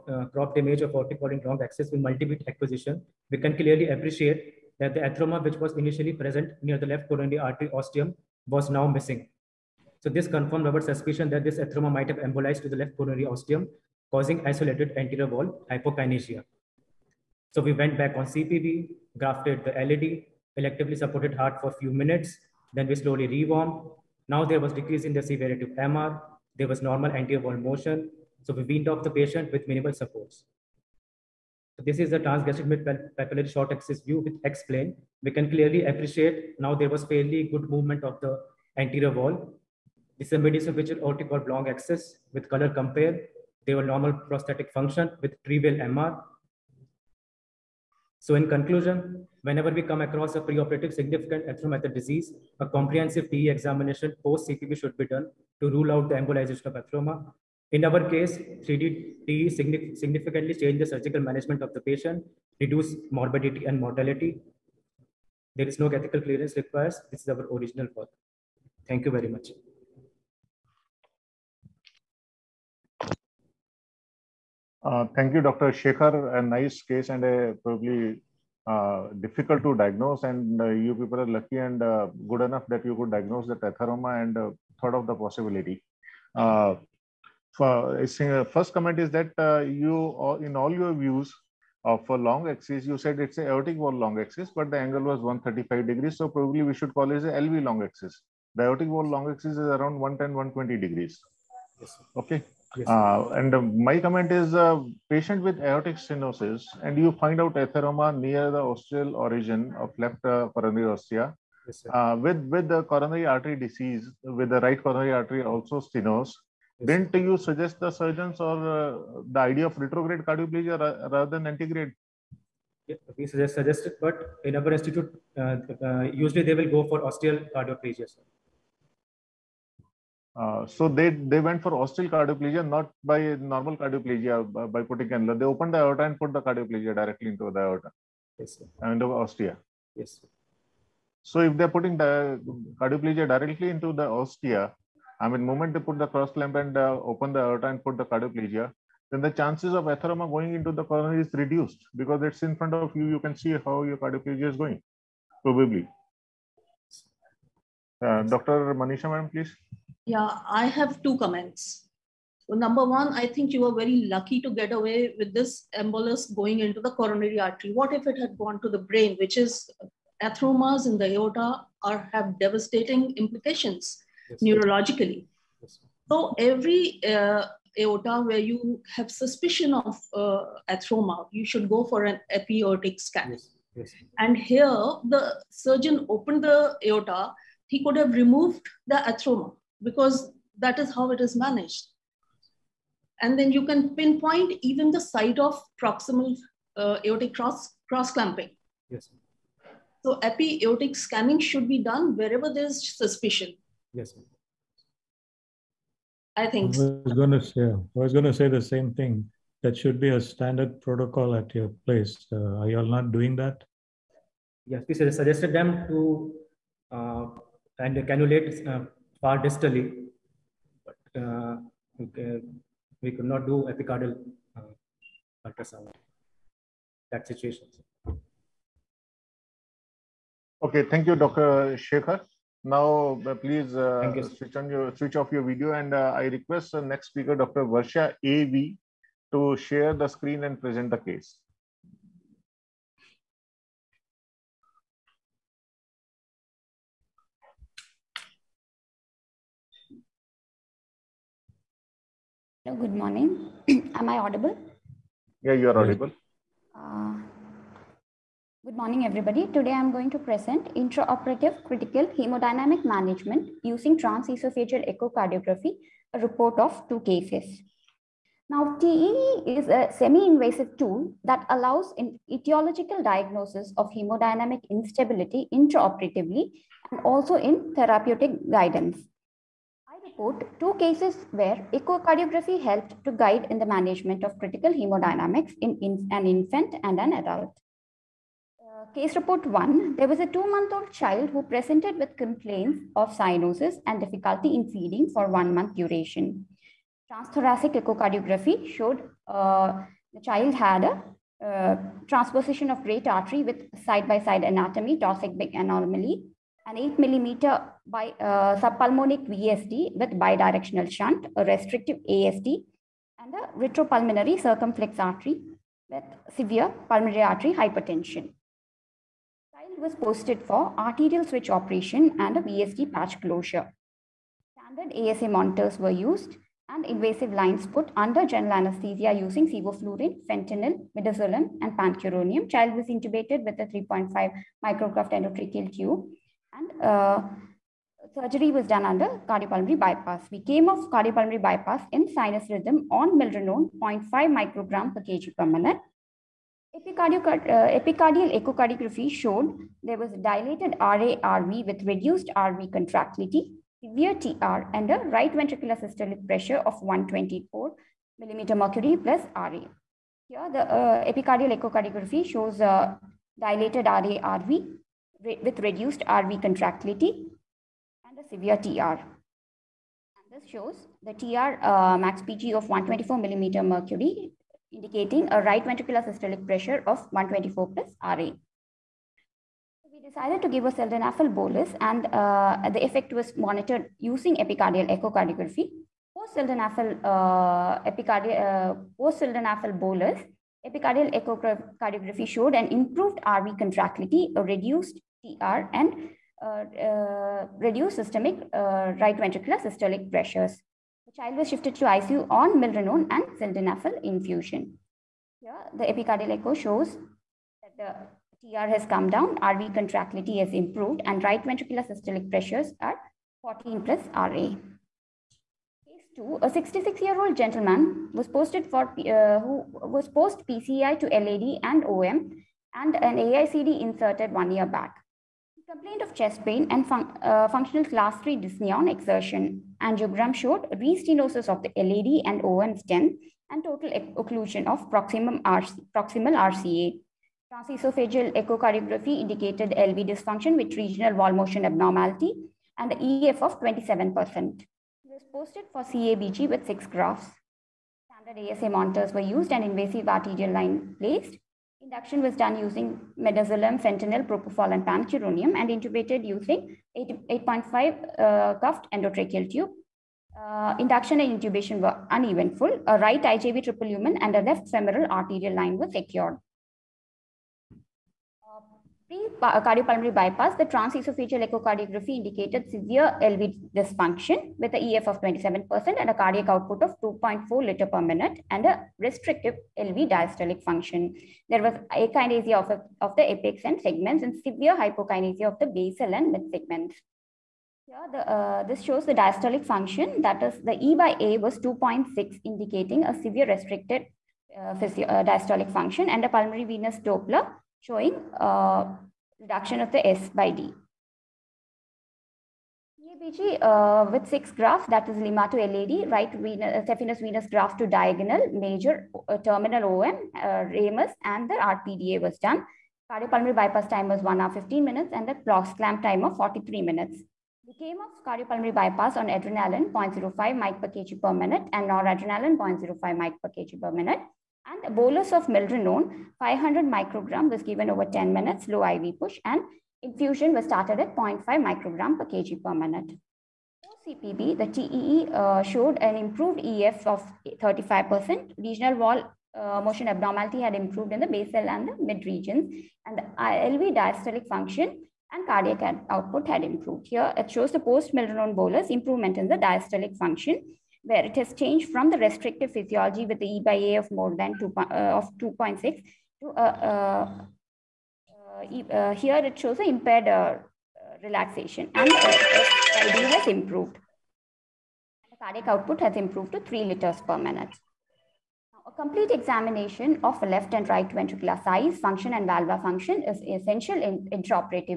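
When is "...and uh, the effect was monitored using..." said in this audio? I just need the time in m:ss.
6:21.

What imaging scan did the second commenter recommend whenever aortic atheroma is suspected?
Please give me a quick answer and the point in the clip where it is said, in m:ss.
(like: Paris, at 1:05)
Epiaortic scan, at 3:02.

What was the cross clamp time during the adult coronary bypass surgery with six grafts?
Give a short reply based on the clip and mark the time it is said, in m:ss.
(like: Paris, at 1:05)
43 minutes, at 8:36.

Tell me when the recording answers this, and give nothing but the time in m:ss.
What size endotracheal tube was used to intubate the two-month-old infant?
5:33.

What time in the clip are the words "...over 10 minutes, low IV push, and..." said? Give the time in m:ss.
8:47.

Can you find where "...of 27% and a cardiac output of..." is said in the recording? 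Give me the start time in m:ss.
7:55.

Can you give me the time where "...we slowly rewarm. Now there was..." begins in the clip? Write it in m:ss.
0:22.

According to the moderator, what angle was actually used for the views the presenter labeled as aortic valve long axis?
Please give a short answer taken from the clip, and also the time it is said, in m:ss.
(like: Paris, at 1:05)
135 degrees, at 1:35.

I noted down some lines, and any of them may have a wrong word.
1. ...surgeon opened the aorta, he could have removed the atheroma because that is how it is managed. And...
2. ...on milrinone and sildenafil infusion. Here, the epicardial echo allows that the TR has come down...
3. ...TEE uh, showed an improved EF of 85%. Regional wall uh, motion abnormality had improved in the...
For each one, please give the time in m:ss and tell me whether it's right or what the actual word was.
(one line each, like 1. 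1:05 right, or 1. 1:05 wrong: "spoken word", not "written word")
1. 3:05 right
2. 6:42 wrong: "shows", not "allows"
3. 8:54 wrong: "35", not "85".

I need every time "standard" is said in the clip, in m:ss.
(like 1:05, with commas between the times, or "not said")
3:30, 5:24, 7:28.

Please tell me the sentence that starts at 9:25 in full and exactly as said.
The cardiac output has improved to 3 liters per minute.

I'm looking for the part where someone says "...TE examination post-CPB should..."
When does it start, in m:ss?
0:53.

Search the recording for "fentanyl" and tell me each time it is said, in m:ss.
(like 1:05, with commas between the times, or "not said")
5:30, 7:33.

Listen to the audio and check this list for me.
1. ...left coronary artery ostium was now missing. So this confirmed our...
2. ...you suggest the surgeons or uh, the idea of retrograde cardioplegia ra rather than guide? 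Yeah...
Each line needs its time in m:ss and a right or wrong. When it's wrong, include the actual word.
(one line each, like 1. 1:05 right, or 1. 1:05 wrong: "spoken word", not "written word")
1. 0:06 right
2. 1:57 wrong: "antegrade", not "guide".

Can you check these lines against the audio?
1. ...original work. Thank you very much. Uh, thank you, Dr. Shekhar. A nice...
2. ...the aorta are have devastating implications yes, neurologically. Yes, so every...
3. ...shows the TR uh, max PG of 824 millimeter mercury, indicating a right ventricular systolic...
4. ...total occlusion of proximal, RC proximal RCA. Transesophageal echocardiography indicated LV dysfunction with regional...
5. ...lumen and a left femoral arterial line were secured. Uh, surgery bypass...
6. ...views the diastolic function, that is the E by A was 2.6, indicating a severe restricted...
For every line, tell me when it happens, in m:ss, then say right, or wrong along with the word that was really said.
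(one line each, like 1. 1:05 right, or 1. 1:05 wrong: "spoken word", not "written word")
1. 1:07 right
2. 2:50 right
3. 6:10 wrong: "124", not "824"
4. 7:13 right
5. 7:43 wrong: "cardiopulmonary", not "surgery"
6. 8:08 wrong: "shows", not "views".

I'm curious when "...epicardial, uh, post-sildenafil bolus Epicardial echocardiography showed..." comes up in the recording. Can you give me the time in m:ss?
6:27.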